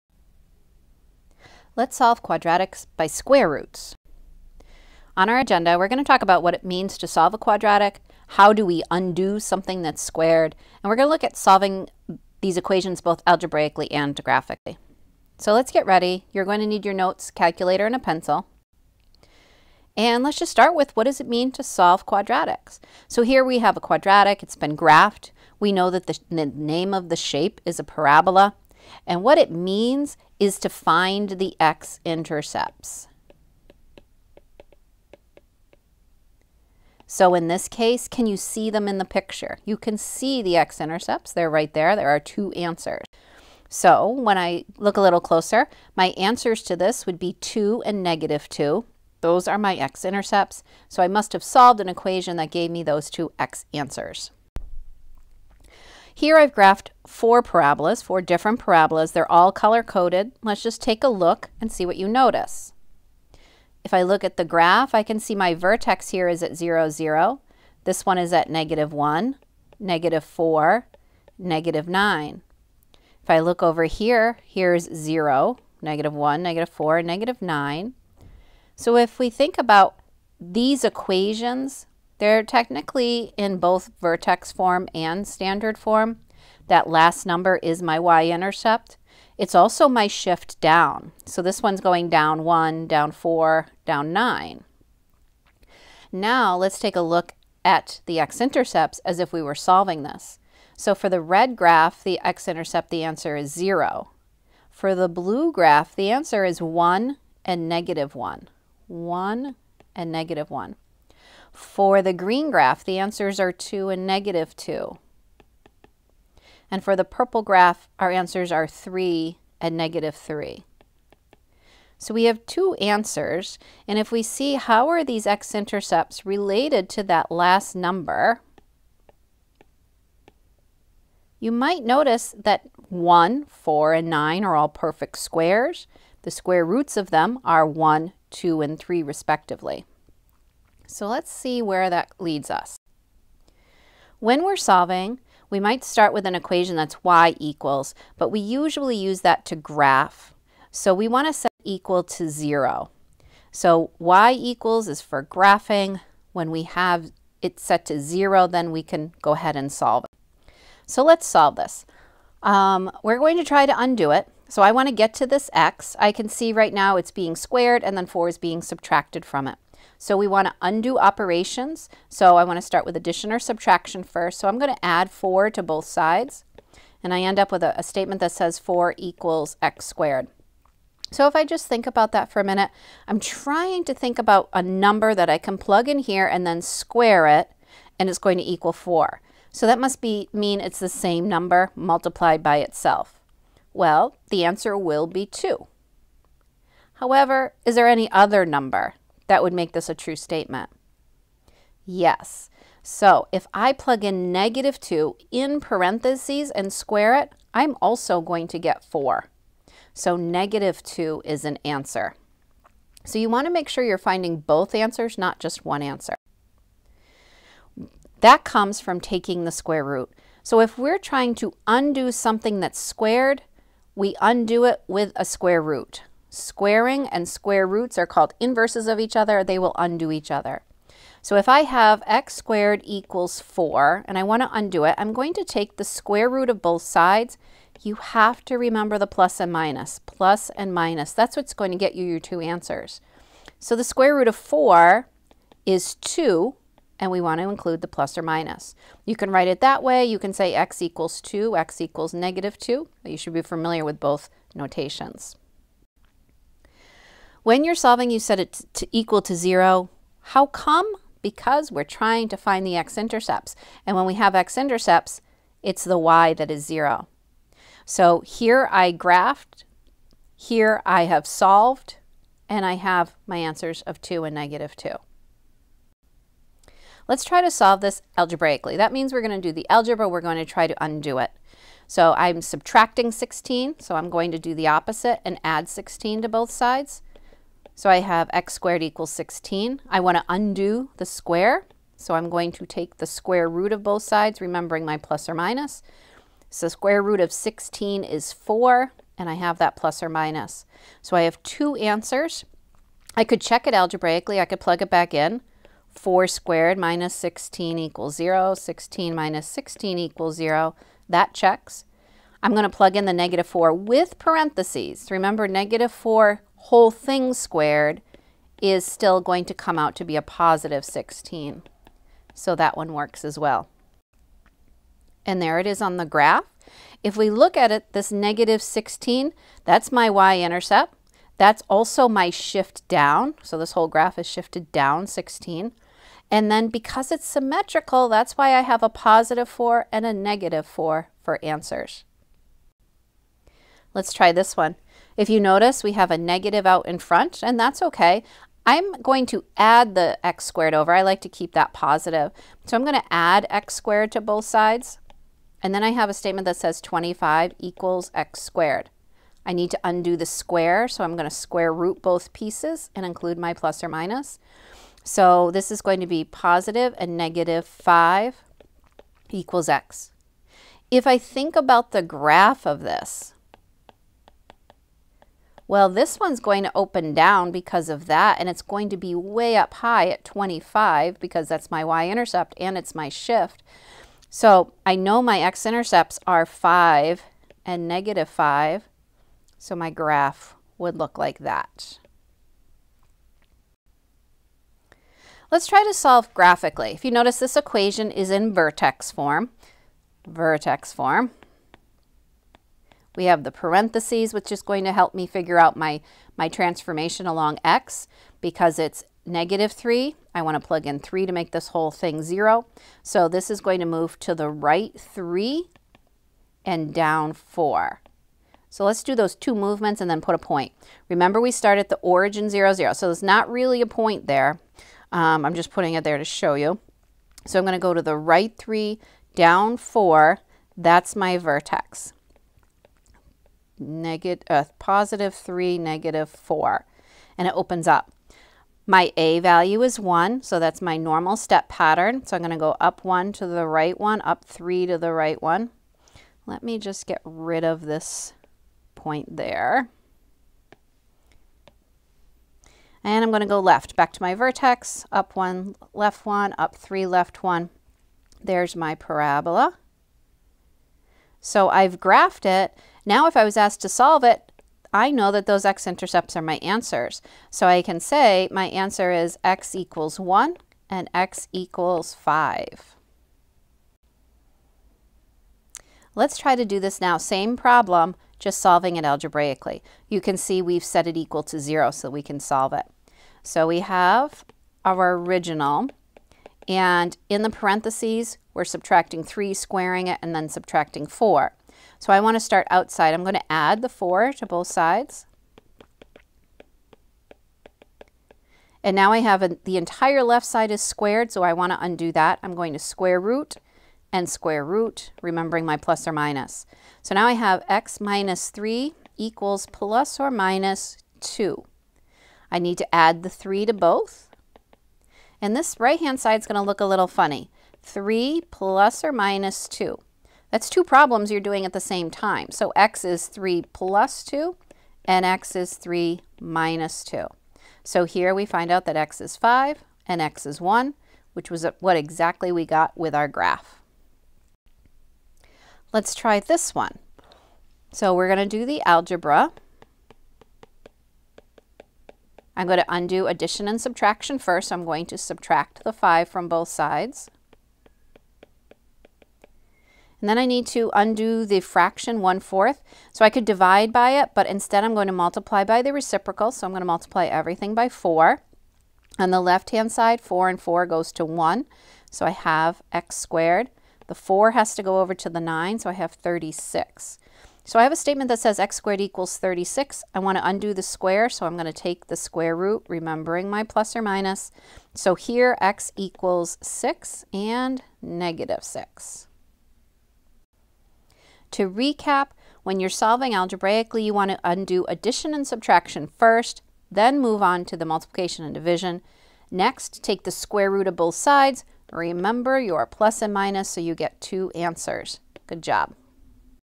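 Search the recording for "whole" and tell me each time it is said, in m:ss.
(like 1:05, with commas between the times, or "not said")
5:16, 5:33, 6:51.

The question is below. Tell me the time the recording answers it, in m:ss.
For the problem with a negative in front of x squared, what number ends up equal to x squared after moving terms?
5:56.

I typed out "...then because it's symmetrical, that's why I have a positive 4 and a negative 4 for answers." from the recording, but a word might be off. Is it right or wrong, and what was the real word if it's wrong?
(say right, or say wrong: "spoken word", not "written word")
right.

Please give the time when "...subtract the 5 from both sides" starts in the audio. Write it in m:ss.
9:05.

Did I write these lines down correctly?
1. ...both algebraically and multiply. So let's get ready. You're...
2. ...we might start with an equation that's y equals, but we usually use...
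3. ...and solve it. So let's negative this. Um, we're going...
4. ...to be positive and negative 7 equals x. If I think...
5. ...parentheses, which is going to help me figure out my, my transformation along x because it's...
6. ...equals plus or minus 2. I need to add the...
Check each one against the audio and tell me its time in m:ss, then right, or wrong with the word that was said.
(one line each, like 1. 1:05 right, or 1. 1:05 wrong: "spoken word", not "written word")
1. 0:13 wrong: "graphically", not "multiply"
2. 2:25 right
3. 2:39 wrong: "solve", not "negative"
4. 6:05 wrong: "5", not "7"
5. 6:43 right
6. 8:29 right.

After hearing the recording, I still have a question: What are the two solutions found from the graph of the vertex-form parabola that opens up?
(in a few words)
1 and 5.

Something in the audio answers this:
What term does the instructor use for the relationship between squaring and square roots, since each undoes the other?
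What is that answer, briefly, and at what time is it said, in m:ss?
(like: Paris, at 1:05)
Inverses, at 3:48.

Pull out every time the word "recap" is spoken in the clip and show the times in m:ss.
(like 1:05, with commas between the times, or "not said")
9:41.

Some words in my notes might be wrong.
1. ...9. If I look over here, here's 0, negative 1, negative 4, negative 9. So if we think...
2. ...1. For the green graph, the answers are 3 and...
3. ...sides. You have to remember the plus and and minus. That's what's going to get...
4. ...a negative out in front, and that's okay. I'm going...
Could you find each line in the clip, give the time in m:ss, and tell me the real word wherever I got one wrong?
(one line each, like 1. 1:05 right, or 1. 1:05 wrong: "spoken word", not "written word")
1. 1:11 right
2. 1:50 wrong: "2", not "3"
3. 3:56 right
4. 5:46 right.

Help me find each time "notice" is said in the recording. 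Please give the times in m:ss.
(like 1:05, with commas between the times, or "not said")
1:02, 2:11, 5:45, 6:37.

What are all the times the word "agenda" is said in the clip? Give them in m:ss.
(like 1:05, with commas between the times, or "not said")
0:05.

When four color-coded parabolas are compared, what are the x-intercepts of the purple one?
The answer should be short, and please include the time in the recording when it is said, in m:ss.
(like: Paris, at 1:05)
3 and -3, at 1:58.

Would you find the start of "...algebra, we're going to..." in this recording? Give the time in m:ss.
4:39.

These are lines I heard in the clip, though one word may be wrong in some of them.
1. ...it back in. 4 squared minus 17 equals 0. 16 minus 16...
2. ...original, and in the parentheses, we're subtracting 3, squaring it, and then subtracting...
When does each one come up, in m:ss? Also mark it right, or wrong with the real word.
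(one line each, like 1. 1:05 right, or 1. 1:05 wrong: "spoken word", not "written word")
1. 5:04 wrong: "16", not "17"
2. 8:05 right.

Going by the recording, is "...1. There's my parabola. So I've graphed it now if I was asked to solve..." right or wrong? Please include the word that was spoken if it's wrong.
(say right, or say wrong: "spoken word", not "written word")
right.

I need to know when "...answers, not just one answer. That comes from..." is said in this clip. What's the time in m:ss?
3:34.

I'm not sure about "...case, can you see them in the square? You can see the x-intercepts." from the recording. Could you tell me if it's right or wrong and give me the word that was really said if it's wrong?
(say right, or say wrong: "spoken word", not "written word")
wrong: "picture", not "square".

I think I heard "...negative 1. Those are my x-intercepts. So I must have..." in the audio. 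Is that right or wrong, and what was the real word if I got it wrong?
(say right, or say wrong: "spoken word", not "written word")
wrong: "2", not "1".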